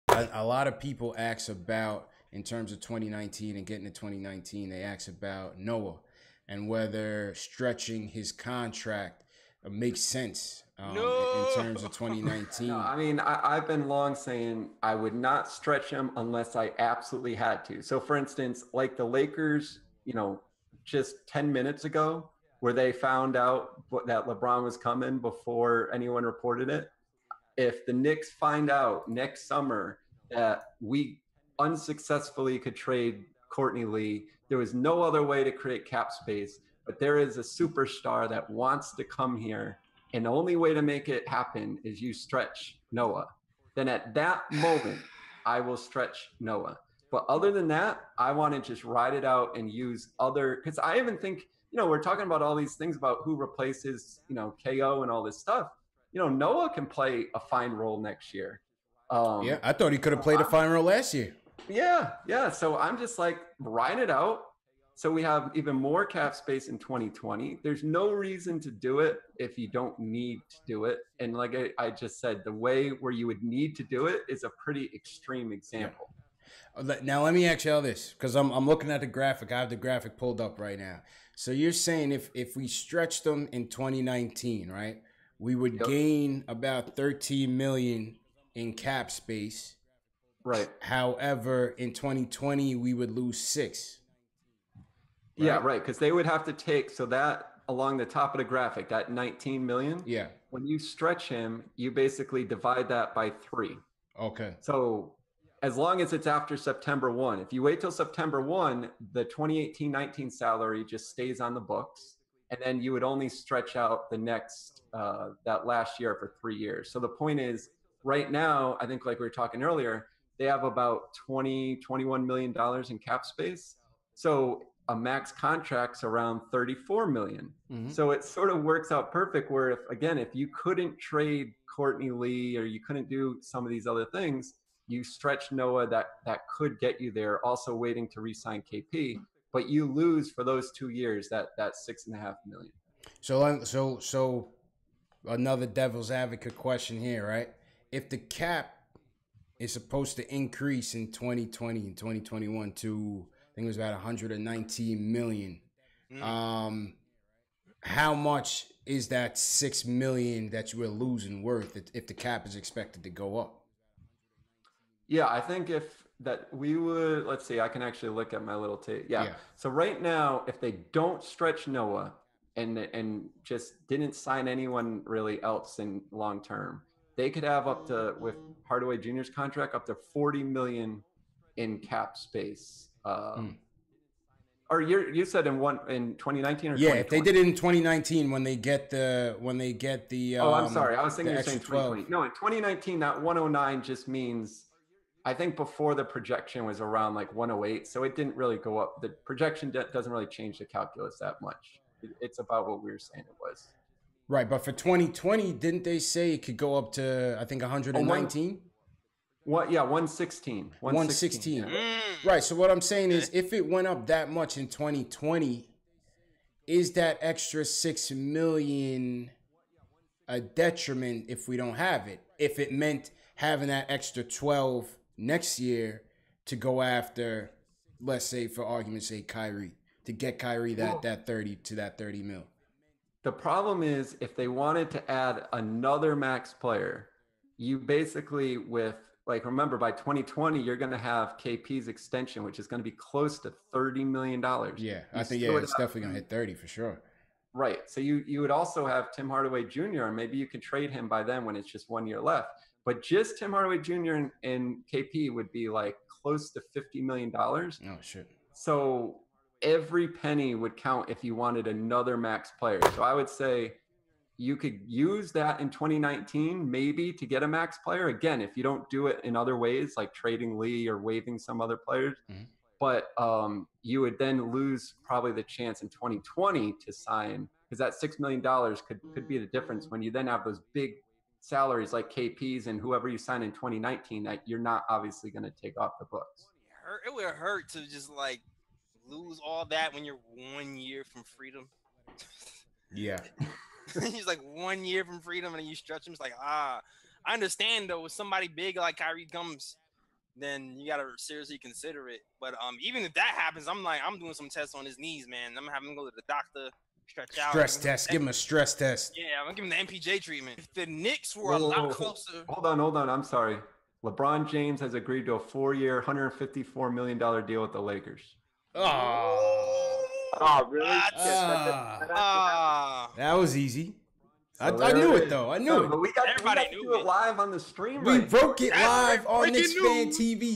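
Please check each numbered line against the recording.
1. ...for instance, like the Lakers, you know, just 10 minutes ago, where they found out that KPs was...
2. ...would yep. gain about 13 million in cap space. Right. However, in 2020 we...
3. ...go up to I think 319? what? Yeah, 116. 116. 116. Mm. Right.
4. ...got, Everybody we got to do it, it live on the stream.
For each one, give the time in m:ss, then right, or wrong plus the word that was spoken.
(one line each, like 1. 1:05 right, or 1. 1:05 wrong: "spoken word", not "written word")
1. 0:17 wrong: "LeBron", not "KPs"
2. 1:25 right
3. 3:26 wrong: "119", not "319"
4. 5:26 right.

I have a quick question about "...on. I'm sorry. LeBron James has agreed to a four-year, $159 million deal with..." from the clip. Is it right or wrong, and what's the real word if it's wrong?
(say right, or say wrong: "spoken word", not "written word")
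wrong: "154", not "159".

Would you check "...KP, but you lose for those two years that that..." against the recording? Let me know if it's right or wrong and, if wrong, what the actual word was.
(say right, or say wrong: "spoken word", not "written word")
right.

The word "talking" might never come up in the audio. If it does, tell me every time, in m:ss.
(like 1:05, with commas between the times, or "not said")
0:52, 1:59.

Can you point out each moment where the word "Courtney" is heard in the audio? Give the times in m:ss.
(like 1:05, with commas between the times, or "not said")
0:33, 2:11.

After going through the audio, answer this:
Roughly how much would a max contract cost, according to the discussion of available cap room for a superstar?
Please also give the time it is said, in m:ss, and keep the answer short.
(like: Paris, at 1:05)
34 million, at 2:06.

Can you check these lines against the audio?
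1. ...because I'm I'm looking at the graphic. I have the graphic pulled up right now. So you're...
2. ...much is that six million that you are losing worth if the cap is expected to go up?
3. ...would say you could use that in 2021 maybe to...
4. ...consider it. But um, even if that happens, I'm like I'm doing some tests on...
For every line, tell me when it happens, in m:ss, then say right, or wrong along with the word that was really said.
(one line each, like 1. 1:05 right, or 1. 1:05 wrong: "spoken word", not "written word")
1. 1:18 right
2. 2:38 right
3. 4:23 wrong: "2019", not "2021"
4. 5:01 right.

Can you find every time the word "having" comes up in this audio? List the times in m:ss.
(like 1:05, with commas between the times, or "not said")
3:43, 5:05.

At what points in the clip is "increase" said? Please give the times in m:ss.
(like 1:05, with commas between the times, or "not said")
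2:30.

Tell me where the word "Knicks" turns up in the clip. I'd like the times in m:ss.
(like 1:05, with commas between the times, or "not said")
0:27, 5:10, 5:29.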